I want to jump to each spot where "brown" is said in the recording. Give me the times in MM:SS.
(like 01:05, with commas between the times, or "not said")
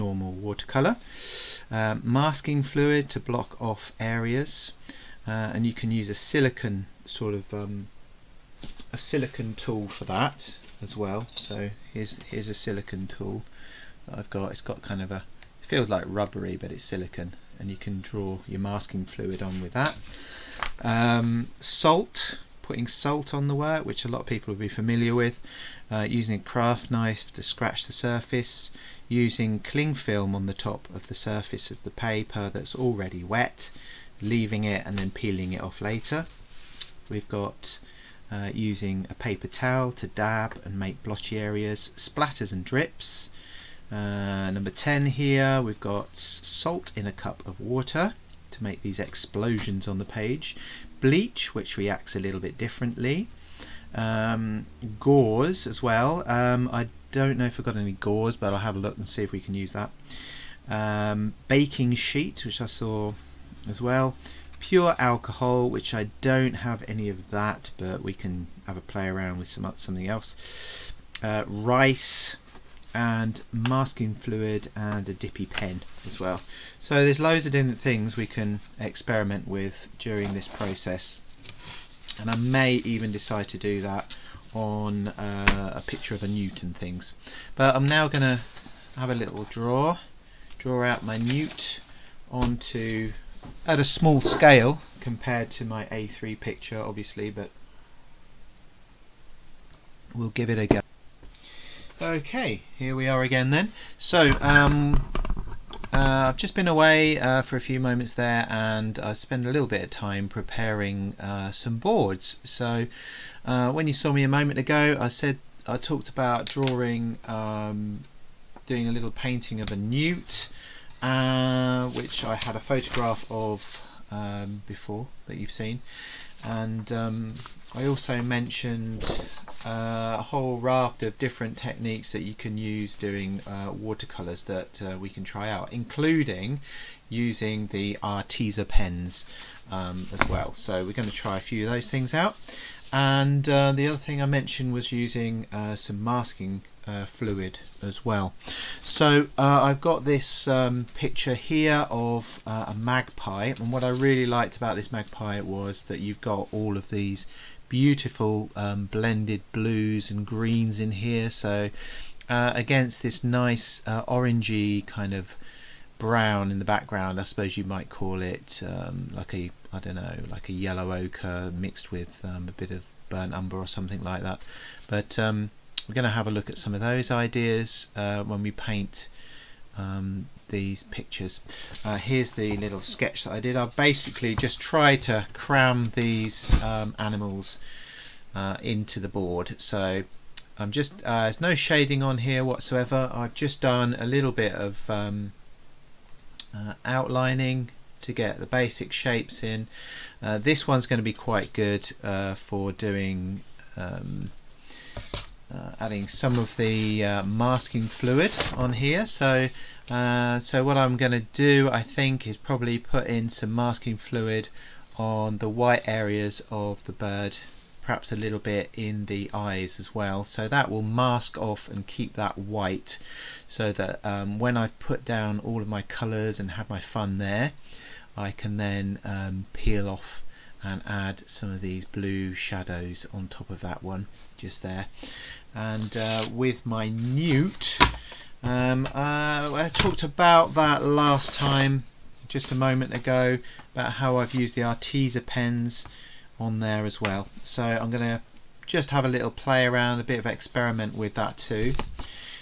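02:45.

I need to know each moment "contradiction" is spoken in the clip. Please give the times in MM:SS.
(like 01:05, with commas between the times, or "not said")
not said.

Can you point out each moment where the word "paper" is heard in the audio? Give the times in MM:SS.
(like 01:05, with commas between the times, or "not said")
00:31, 00:39.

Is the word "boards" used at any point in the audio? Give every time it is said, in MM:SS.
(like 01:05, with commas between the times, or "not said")
01:51, 03:09.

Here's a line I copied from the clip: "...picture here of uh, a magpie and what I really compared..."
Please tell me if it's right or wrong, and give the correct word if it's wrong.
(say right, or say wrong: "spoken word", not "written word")
wrong: "liked", not "compared".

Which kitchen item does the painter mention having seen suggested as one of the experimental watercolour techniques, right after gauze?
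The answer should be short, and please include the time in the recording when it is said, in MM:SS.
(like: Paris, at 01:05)
Baking sheet, at 01:01.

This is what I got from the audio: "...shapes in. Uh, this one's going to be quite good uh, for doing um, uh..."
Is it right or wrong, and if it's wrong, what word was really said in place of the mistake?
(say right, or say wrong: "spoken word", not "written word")
right.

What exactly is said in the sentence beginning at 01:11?
Uh, rice and masking fluid and a dippy pen as well.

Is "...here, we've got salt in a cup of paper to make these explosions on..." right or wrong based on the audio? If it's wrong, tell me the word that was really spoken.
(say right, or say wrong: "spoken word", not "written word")
wrong: "water", not "paper".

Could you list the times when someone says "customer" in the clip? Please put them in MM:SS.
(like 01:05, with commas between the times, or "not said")
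not said.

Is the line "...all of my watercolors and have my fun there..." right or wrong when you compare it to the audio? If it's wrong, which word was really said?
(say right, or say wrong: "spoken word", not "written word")
wrong: "colors", not "watercolors".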